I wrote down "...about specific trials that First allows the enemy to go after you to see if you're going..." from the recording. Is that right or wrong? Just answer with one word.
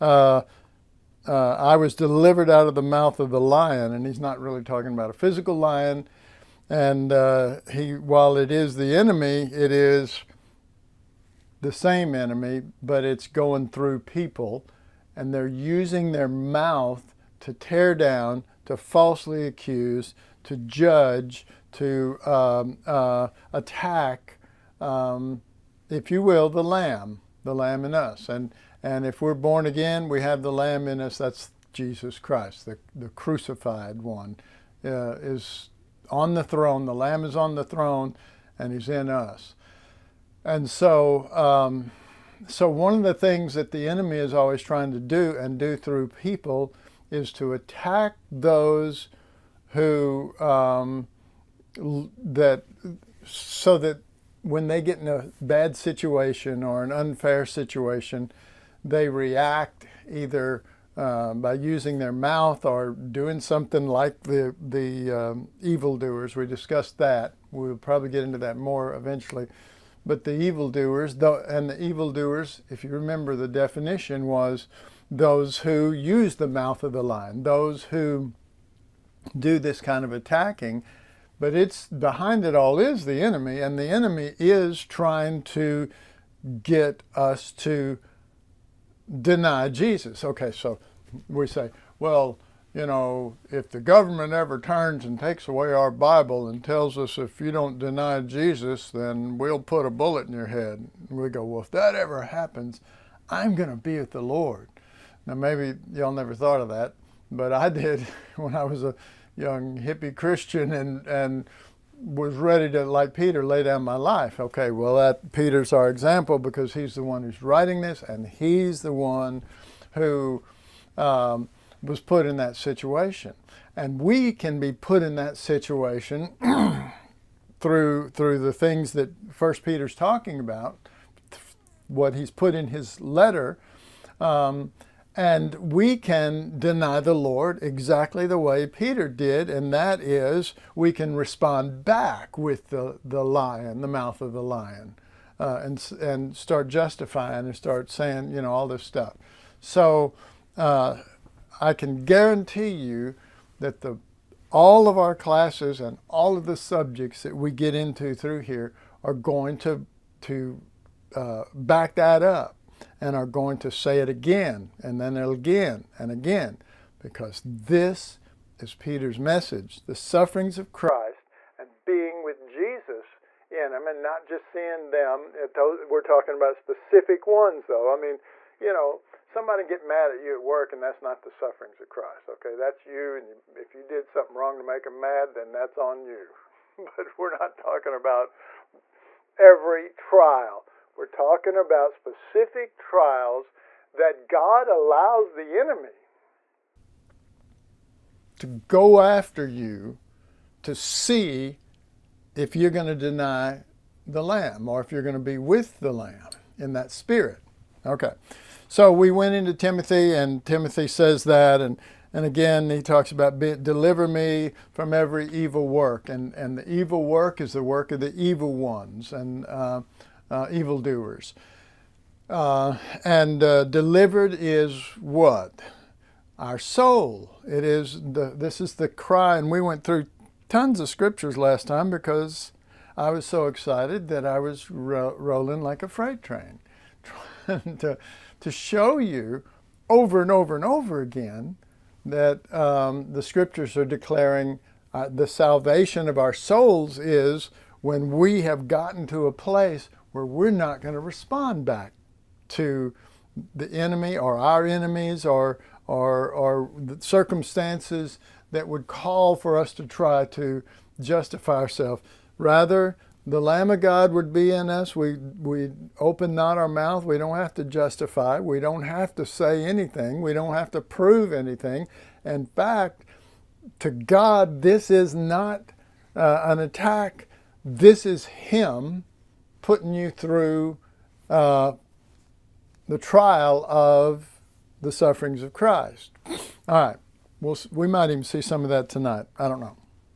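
wrong.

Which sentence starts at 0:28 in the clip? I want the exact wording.
And, and if we're born again, we have the Lamb in us.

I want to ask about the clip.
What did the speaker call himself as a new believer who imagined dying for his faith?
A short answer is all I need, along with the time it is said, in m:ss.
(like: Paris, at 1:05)
young hippie Christian, at 1:49.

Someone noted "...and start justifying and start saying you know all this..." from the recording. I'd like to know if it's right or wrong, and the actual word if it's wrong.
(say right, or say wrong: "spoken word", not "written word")
right.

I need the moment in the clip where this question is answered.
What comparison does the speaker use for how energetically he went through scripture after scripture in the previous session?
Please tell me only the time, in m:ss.
3:55.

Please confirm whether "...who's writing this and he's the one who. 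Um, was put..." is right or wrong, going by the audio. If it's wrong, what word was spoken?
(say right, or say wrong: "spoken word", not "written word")
right.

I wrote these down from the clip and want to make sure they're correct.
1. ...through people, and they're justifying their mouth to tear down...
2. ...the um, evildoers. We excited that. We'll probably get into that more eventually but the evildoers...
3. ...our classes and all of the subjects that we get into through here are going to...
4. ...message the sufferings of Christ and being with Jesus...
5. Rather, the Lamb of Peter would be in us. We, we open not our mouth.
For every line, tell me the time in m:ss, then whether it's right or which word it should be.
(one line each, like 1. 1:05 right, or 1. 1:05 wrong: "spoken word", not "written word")
1. 0:13 wrong: "using", not "justifying"
2. 1:04 wrong: "discussed", not "excited"
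3. 2:34 right
4. 2:49 right
5. 4:22 wrong: "God", not "Peter".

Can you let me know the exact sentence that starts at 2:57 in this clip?
I mean, you know, somebody get mad at you at work, and that's not the sufferings of Christ.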